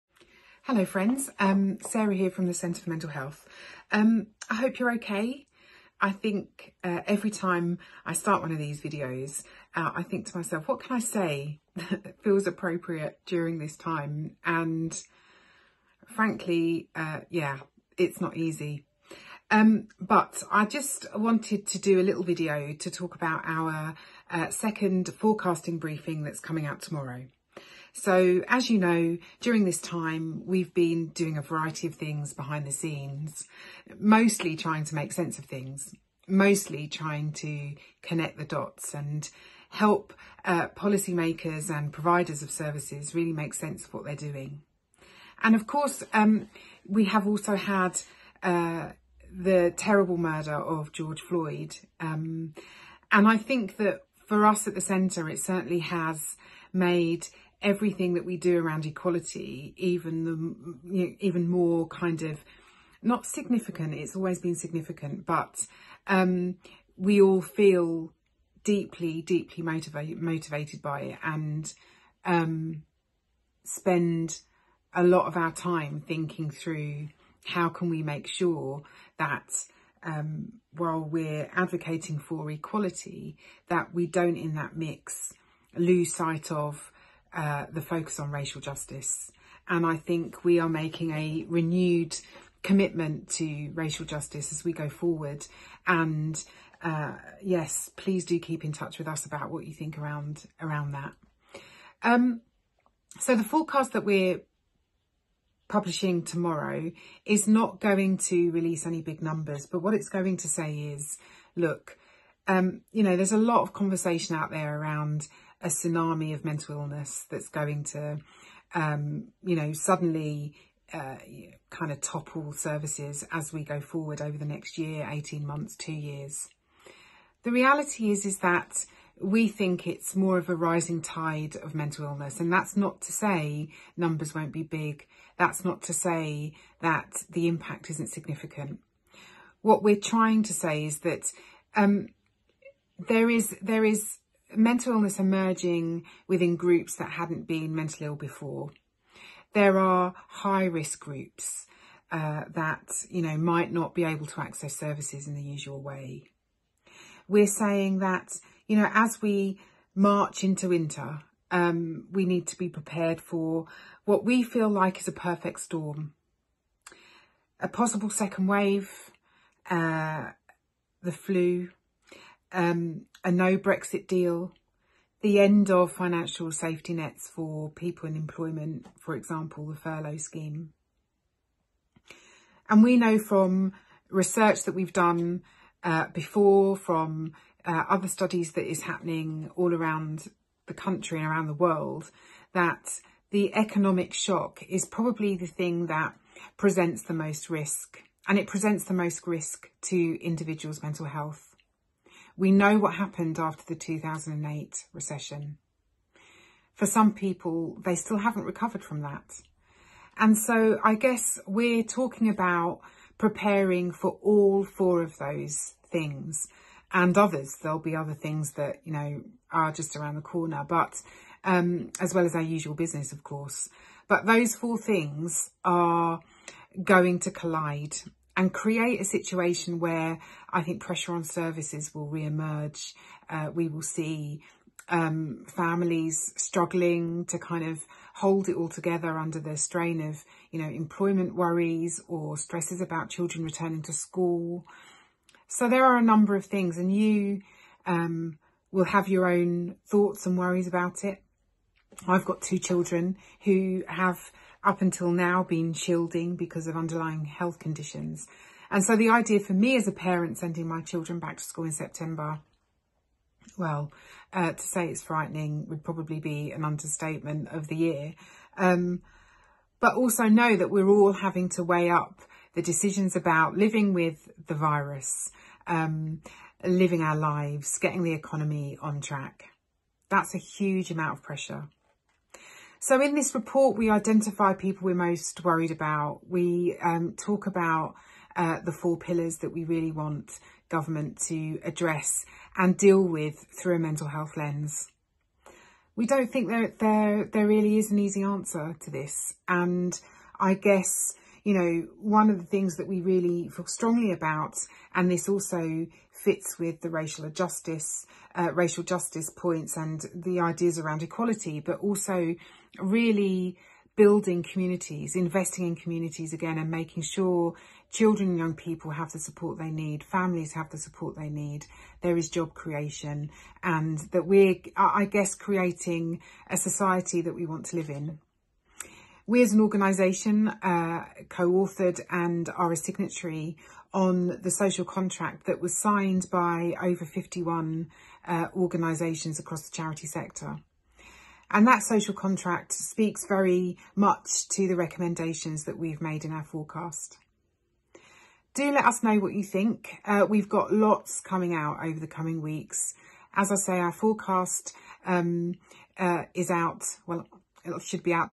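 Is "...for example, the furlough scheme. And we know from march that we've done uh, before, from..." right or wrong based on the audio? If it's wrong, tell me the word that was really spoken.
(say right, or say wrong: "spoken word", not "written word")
wrong: "research", not "march".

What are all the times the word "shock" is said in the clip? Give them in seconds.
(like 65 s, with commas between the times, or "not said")
194 s.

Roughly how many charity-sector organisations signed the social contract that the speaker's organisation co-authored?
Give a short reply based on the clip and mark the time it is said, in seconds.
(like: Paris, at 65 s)
51, at 337 s.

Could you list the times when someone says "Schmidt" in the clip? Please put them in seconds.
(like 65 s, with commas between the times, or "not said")
not said.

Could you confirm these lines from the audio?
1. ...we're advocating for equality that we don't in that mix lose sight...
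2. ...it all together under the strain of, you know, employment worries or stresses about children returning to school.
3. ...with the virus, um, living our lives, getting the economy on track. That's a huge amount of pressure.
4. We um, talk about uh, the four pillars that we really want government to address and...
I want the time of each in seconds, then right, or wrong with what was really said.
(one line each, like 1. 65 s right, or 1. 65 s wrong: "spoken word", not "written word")
1. 80 s right
2. 238 s right
3. 273 s right
4. 286 s right.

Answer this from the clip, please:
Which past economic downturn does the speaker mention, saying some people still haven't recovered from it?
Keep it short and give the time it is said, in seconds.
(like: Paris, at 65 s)
2008 recession, at 203 s.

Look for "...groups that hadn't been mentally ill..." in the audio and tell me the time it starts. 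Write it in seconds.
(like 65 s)
146 s.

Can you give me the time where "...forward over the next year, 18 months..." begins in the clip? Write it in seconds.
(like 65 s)
123 s.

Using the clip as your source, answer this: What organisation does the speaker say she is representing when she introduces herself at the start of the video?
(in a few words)
Centre for Mental Health.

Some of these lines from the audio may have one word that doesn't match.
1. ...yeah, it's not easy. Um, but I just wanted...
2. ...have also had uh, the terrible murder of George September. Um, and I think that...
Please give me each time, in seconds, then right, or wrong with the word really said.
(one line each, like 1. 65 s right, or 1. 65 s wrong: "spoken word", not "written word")
1. 17 s right
2. 47 s wrong: "Floyd", not "September".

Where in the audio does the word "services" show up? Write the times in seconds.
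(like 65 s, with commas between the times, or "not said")
42 s, 122 s, 154 s, 231 s.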